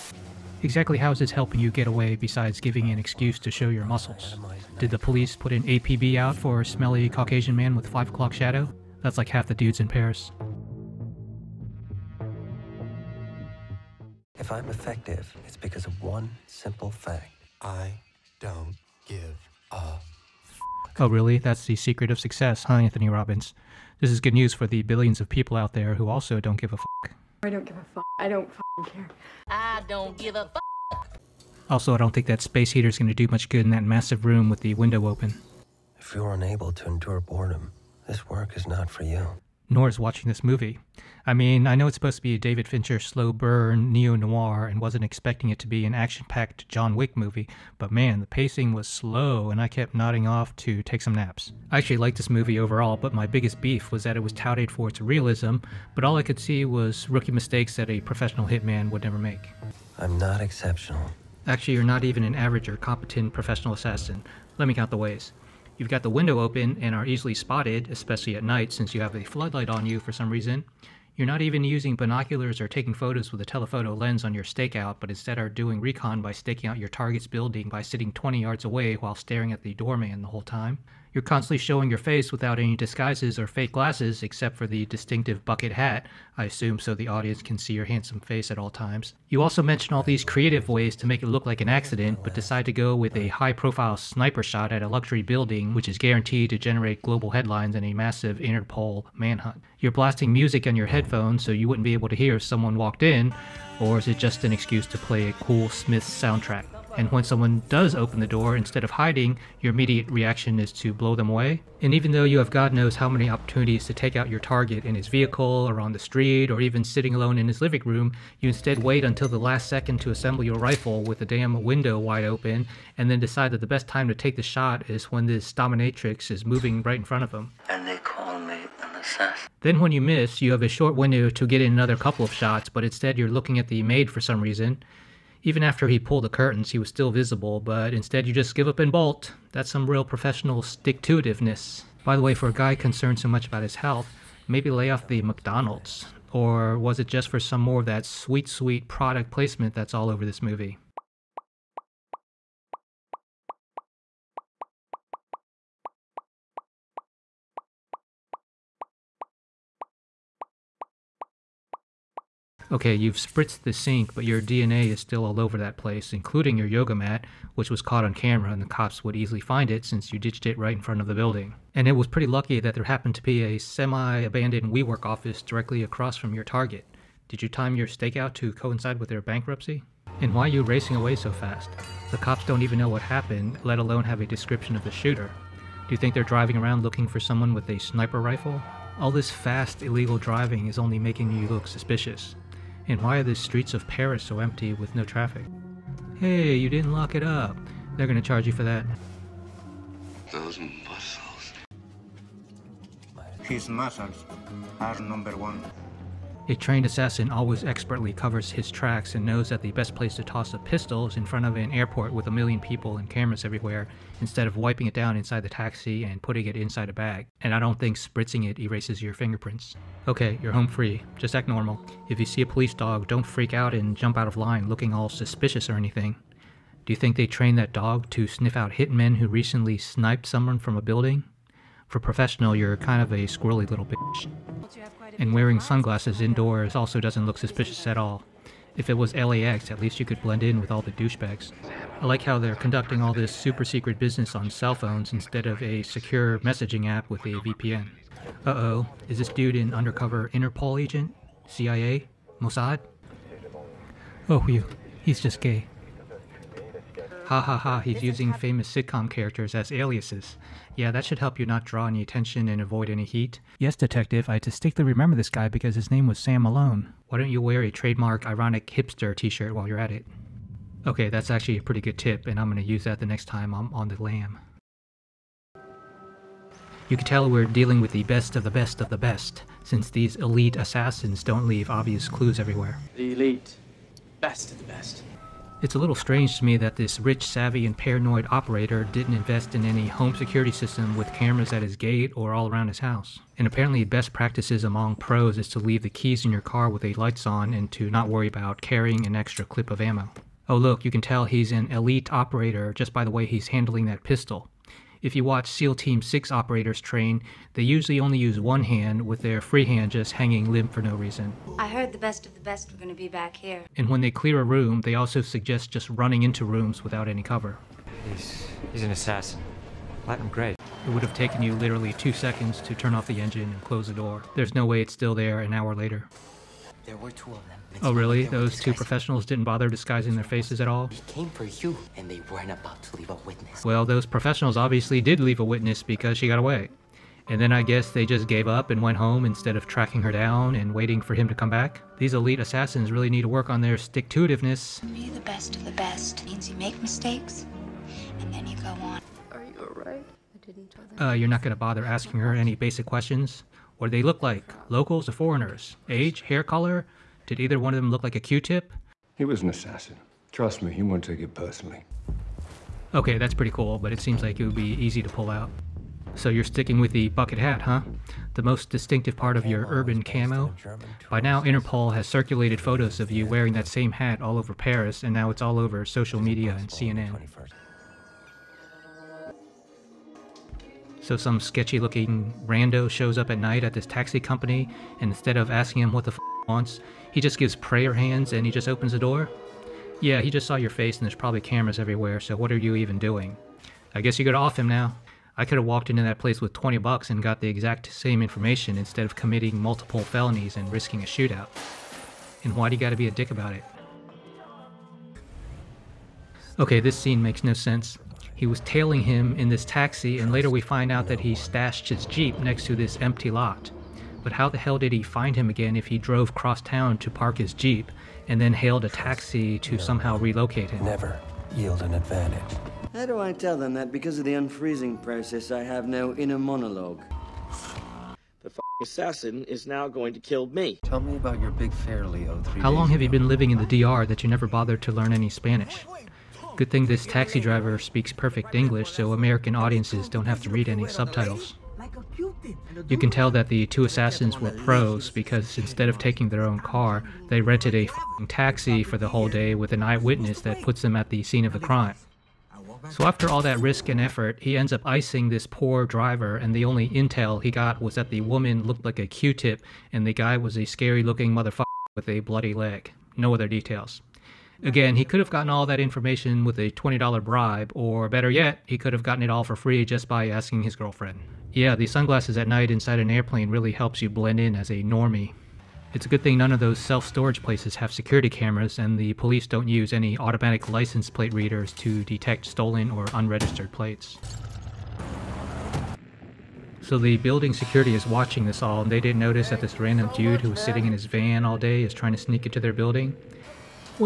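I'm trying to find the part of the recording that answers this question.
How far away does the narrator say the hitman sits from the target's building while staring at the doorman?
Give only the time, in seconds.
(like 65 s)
78 s.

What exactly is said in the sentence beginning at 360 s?
Trust me, he won't take it personally.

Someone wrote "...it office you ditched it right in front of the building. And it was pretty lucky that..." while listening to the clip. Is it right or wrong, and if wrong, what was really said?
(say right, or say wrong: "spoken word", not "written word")
wrong: "since", not "office".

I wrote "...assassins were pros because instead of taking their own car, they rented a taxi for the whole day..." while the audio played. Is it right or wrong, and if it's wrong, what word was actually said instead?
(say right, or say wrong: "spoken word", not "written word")
right.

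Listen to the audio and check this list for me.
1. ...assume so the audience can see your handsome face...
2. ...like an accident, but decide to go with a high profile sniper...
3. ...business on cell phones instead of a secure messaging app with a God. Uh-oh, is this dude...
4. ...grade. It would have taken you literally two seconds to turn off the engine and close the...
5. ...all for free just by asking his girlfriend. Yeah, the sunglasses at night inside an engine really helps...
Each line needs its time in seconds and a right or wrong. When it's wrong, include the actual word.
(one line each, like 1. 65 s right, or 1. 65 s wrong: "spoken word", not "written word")
1. 86 s right
2. 91 s right
3. 243 s wrong: "VPN", not "God"
4. 320 s right
5. 469 s wrong: "airplane", not "engine".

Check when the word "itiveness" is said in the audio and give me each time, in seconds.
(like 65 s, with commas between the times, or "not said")
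141 s, 343 s.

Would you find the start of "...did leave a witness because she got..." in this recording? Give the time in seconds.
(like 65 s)
335 s.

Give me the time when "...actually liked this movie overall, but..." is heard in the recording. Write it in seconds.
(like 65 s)
51 s.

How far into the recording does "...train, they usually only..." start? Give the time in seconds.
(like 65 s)
306 s.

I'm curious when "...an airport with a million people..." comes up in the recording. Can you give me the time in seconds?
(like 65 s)
211 s.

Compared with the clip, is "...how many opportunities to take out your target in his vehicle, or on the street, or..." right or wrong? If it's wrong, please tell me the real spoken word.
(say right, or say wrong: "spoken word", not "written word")
right.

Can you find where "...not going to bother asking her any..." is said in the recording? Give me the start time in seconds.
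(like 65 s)
351 s.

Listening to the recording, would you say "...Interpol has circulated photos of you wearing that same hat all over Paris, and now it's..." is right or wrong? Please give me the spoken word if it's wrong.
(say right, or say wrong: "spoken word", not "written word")
right.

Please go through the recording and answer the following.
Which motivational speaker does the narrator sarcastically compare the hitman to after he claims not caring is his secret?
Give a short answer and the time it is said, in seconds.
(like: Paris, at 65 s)
Anthony Robbins, at 22 s.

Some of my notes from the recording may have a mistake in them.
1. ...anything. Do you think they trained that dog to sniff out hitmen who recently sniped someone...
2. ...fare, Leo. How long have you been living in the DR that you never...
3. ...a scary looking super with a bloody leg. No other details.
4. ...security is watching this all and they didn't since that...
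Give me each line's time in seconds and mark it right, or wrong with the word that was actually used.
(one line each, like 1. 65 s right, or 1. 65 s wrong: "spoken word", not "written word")
1. 225 s right
2. 431 s right
3. 460 s wrong: "motherfucker", not "super"
4. 487 s wrong: "notice", not "since".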